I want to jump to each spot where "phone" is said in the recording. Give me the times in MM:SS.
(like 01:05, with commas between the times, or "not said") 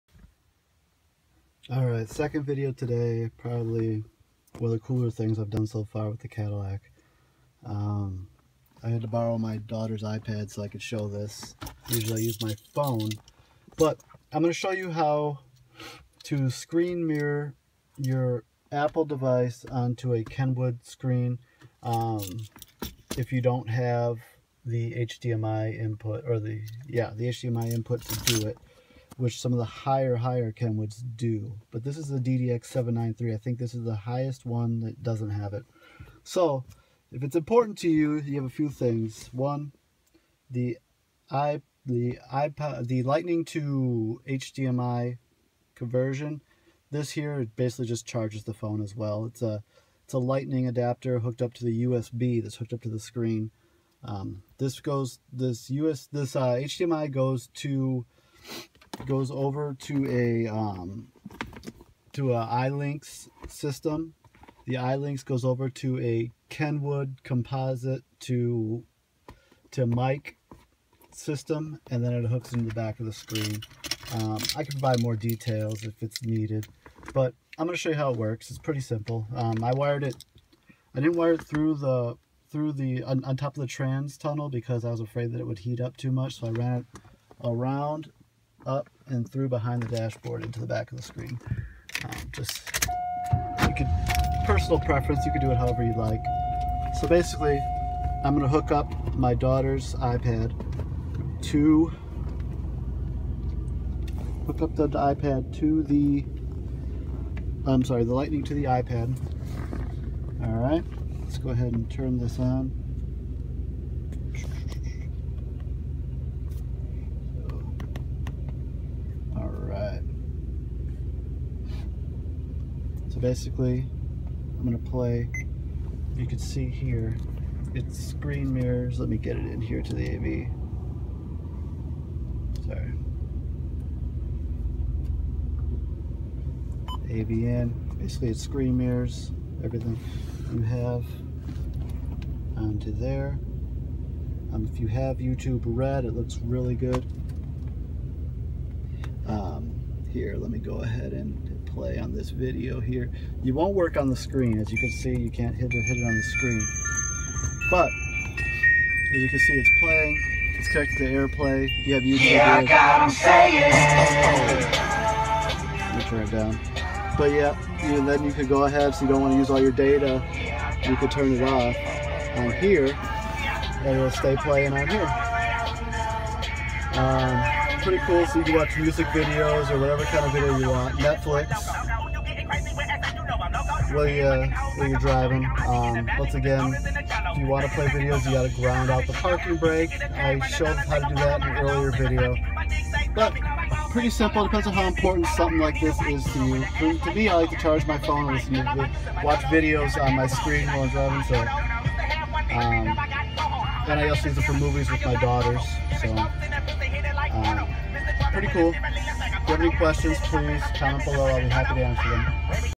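00:12, 00:48, 03:17.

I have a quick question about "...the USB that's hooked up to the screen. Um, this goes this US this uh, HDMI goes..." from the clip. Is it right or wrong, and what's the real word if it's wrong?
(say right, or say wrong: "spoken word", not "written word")
right.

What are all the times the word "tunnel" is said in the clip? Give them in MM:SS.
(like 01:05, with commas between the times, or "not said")
01:24.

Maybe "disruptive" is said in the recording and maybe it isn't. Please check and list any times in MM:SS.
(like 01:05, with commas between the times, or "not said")
not said.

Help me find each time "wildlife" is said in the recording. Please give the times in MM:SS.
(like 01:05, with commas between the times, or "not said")
not said.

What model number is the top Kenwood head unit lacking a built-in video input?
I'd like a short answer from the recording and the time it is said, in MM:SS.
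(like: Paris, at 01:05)
DDX793, at 00:32.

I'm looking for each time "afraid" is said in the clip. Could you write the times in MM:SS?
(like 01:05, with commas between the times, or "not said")
01:24.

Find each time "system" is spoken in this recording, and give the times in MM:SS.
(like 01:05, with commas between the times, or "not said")
01:03, 01:11.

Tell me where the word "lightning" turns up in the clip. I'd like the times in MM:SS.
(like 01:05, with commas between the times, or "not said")
00:43, 00:50, 01:48.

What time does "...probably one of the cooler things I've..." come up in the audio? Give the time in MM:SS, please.
00:03.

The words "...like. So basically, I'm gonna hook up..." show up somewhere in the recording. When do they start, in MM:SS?
01:35.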